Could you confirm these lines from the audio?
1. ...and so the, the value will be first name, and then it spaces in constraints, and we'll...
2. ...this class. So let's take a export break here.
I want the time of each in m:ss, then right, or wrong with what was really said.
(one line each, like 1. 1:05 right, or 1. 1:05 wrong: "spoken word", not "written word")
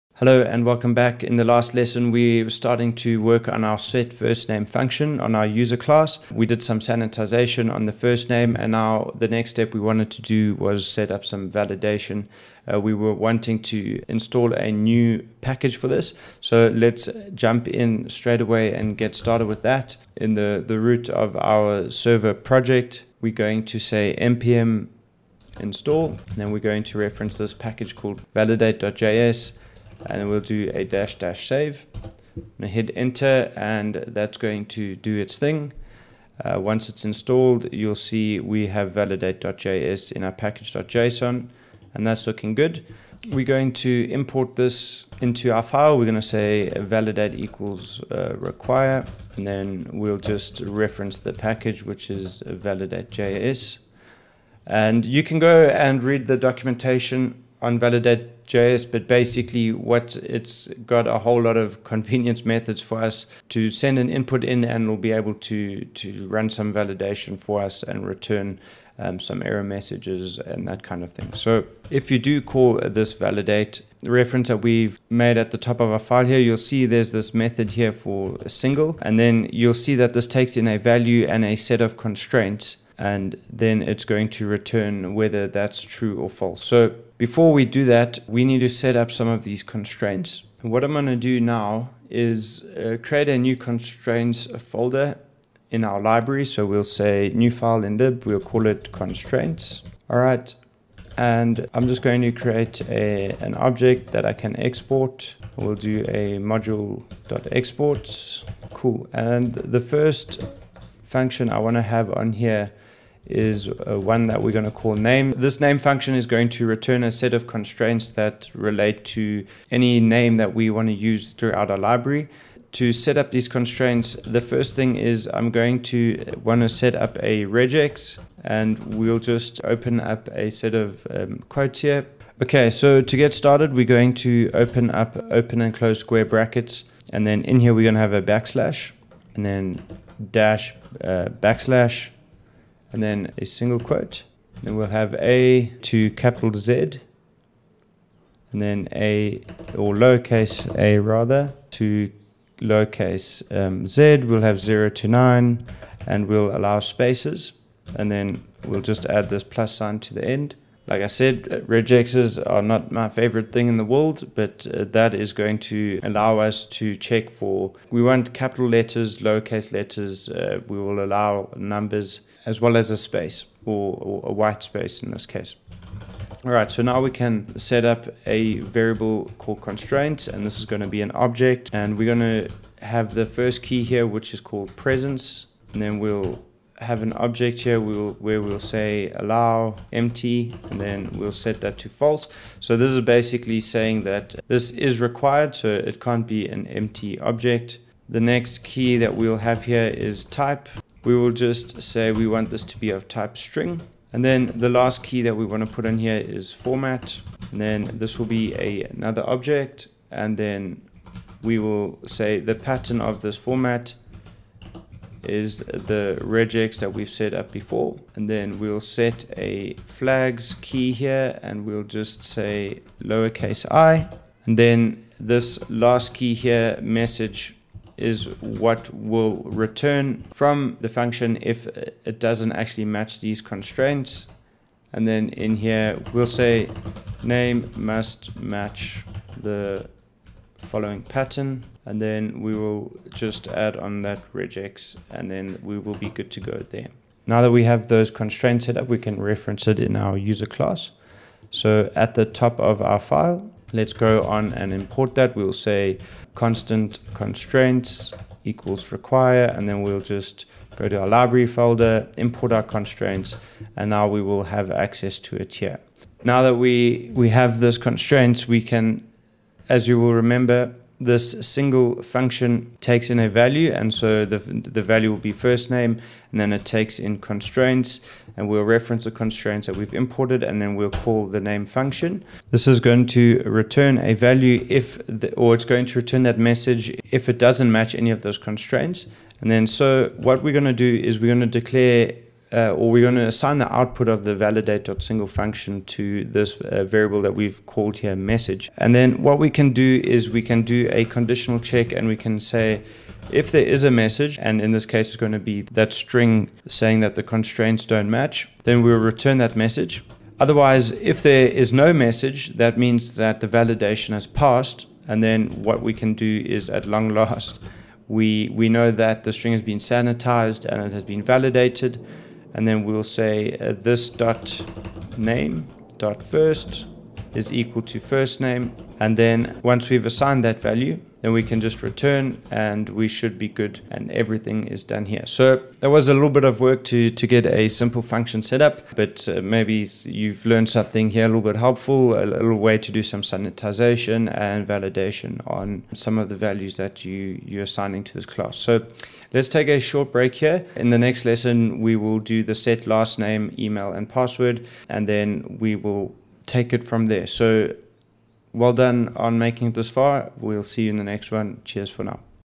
1. 4:33 wrong: "takes", not "spaces"
2. 5:48 wrong: "short", not "export".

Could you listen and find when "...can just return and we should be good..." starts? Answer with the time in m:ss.
5:31.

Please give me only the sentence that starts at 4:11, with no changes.
So at the top of our file, let's go on and import that.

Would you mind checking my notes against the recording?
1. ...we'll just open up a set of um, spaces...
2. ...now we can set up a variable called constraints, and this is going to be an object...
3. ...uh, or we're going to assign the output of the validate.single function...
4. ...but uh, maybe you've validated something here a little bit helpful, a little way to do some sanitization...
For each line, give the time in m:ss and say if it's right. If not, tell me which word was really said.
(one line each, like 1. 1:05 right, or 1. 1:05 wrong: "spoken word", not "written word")
1. 2:08 wrong: "quotes", not "spaces"
2. 2:56 right
3. 4:52 right
4. 5:38 wrong: "learned", not "validated".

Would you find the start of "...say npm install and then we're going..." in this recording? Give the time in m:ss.
0:23.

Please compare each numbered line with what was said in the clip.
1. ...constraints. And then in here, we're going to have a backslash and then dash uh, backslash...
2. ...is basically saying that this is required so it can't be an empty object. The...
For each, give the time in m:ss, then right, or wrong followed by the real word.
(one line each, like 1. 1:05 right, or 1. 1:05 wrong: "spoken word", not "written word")
1. 2:16 wrong: "brackets", not "constraints"
2. 3:12 right.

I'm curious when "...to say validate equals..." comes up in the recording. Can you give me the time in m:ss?
0:46.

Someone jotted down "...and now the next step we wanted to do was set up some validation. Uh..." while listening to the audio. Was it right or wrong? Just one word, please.
right.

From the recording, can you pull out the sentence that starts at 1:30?
what I'm going to do now is uh, create a new constraints folder in our library.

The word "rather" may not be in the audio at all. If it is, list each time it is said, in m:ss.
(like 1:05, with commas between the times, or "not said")
2:30.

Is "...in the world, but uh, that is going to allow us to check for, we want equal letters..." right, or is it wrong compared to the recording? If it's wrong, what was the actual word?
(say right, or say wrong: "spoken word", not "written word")
wrong: "capital", not "equal".